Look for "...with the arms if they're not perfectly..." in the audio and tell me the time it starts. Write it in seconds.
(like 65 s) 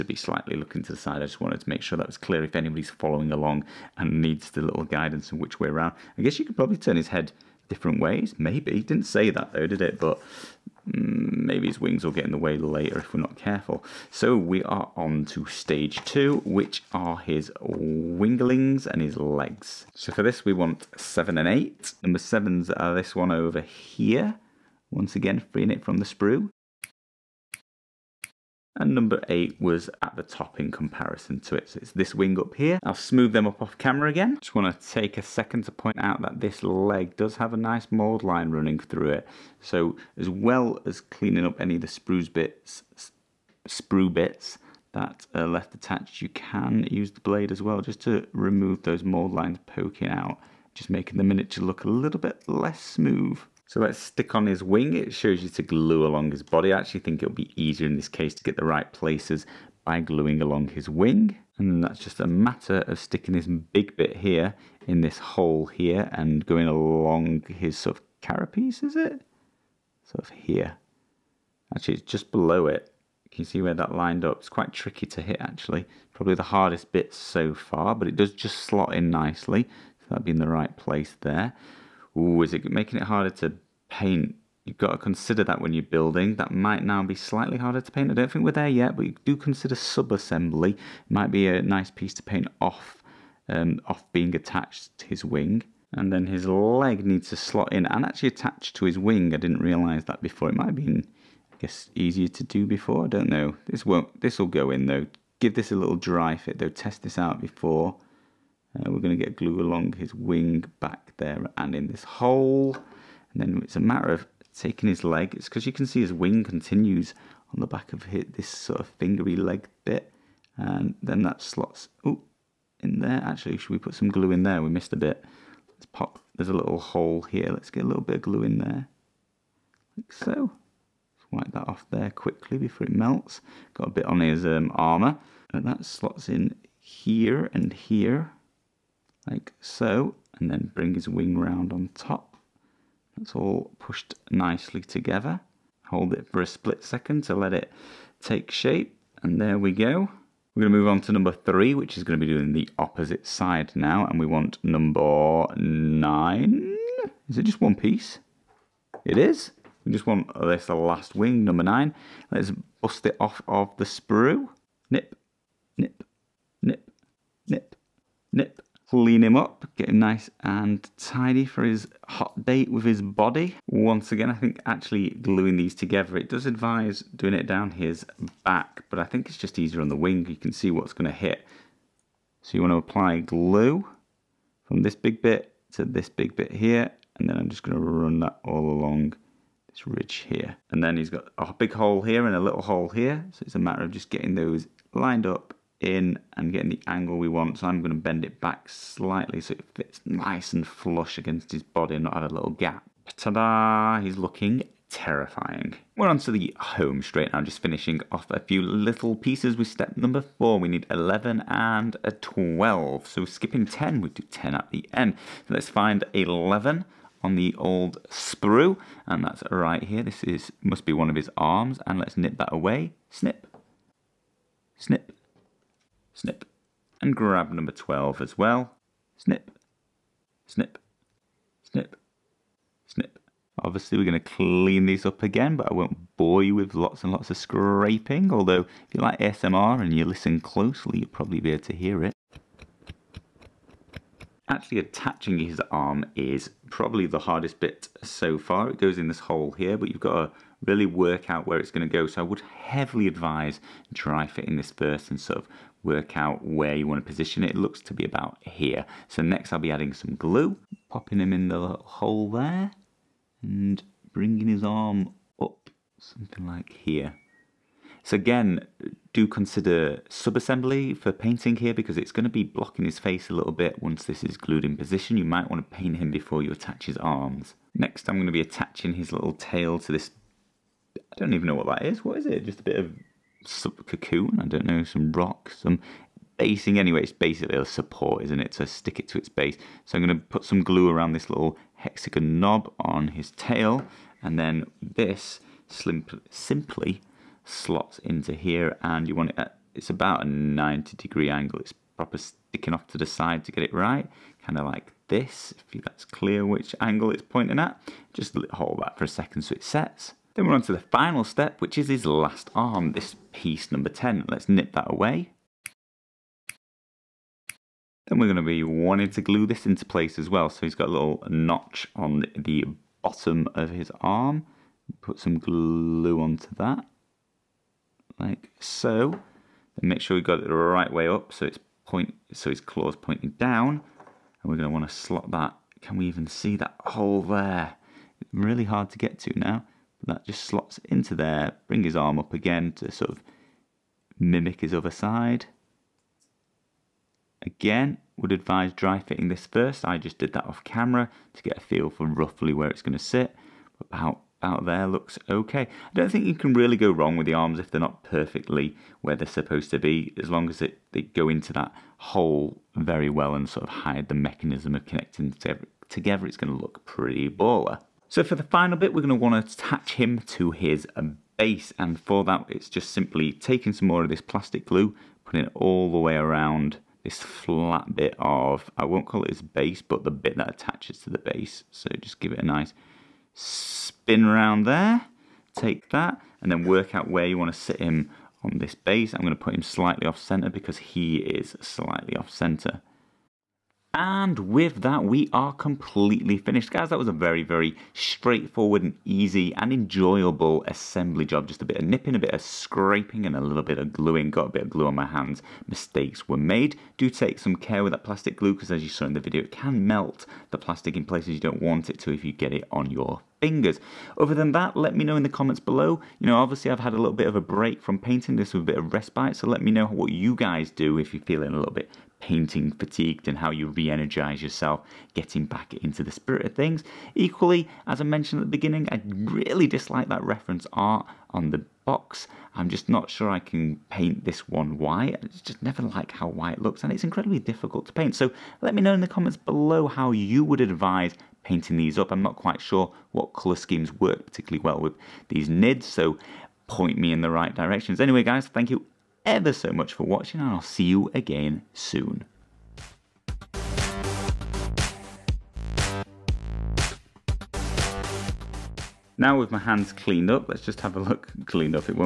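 357 s.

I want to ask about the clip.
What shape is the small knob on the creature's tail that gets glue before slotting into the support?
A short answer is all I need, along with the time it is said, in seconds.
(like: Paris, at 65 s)
Hexagon, at 291 s.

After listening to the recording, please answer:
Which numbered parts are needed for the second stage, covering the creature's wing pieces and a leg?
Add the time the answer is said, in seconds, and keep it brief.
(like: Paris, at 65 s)
7 and 8, at 20 s.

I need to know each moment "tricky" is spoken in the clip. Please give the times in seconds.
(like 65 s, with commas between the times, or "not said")
74 s.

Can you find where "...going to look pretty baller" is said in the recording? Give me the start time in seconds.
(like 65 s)
366 s.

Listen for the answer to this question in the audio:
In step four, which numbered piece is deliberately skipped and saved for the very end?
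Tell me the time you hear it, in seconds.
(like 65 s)
213 s.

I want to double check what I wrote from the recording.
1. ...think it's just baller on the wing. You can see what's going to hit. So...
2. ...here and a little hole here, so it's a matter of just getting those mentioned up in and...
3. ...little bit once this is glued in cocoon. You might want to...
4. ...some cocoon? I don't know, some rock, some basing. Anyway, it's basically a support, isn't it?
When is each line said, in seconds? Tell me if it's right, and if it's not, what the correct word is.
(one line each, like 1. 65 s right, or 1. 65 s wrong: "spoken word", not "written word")
1. 179 s wrong: "easier", not "baller"
2. 191 s wrong: "lined", not "mentioned"
3. 273 s wrong: "position", not "cocoon"
4. 283 s right.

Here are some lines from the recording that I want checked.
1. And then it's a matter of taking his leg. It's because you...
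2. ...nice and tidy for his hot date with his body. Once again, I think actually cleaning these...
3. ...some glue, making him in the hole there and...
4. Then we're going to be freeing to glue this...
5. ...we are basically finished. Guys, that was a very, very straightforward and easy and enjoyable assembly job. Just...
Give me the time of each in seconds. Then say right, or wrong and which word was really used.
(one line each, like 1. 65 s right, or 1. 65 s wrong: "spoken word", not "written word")
1. 113 s right
2. 169 s wrong: "gluing", not "cleaning"
3. 259 s wrong: "popping", not "making"
4. 318 s wrong: "wanting", not "freeing"
5. 395 s wrong: "completely", not "basically".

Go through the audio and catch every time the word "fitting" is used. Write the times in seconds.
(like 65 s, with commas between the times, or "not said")
254 s, 348 s.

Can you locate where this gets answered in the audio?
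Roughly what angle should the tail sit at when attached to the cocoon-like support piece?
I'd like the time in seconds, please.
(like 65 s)
300 s.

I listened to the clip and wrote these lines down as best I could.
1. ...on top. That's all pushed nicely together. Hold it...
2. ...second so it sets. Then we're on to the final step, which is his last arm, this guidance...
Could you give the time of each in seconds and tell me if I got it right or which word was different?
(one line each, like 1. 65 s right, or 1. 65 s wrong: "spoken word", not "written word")
1. 141 s right
2. 309 s wrong: "piece", not "guidance".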